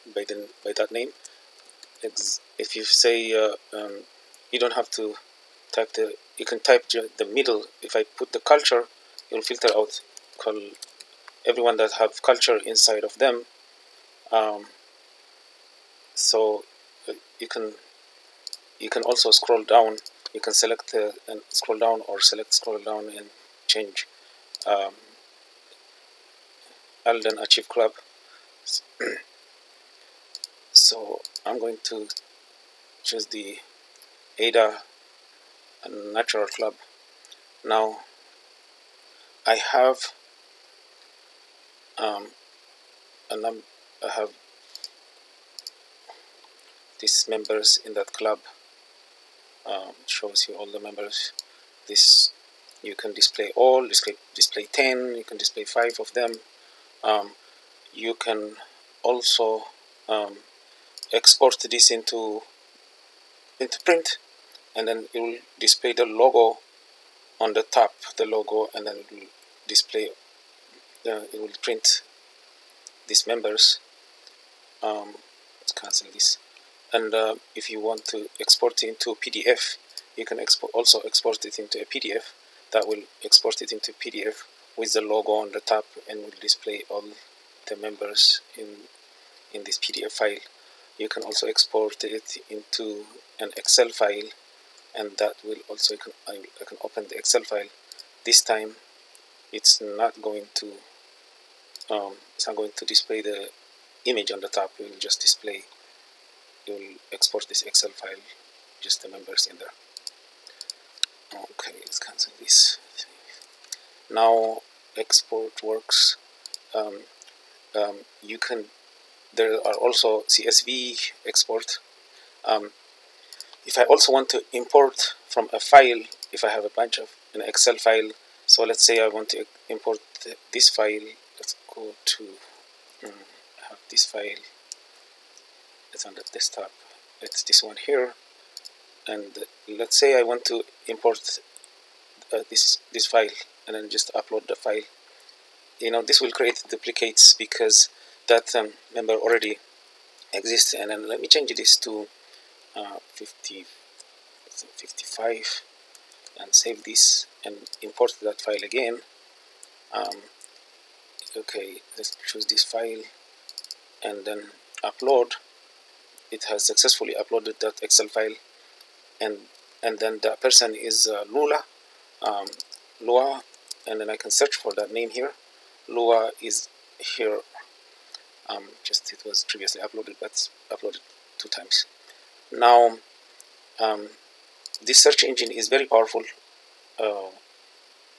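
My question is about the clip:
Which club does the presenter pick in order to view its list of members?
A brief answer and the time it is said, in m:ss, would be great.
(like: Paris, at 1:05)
Ada Natural Club, at 0:34.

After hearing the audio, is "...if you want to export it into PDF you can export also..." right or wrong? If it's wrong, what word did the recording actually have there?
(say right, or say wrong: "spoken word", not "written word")
right.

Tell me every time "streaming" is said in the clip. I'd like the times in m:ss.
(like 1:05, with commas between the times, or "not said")
not said.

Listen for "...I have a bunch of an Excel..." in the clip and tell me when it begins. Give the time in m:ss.
2:06.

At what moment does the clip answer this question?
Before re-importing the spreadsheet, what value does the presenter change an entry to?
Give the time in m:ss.
2:34.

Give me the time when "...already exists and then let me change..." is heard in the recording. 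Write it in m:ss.
2:29.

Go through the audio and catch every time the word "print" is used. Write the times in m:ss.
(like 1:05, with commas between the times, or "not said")
1:03, 1:11.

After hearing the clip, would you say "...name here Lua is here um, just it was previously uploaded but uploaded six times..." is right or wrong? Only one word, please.
wrong.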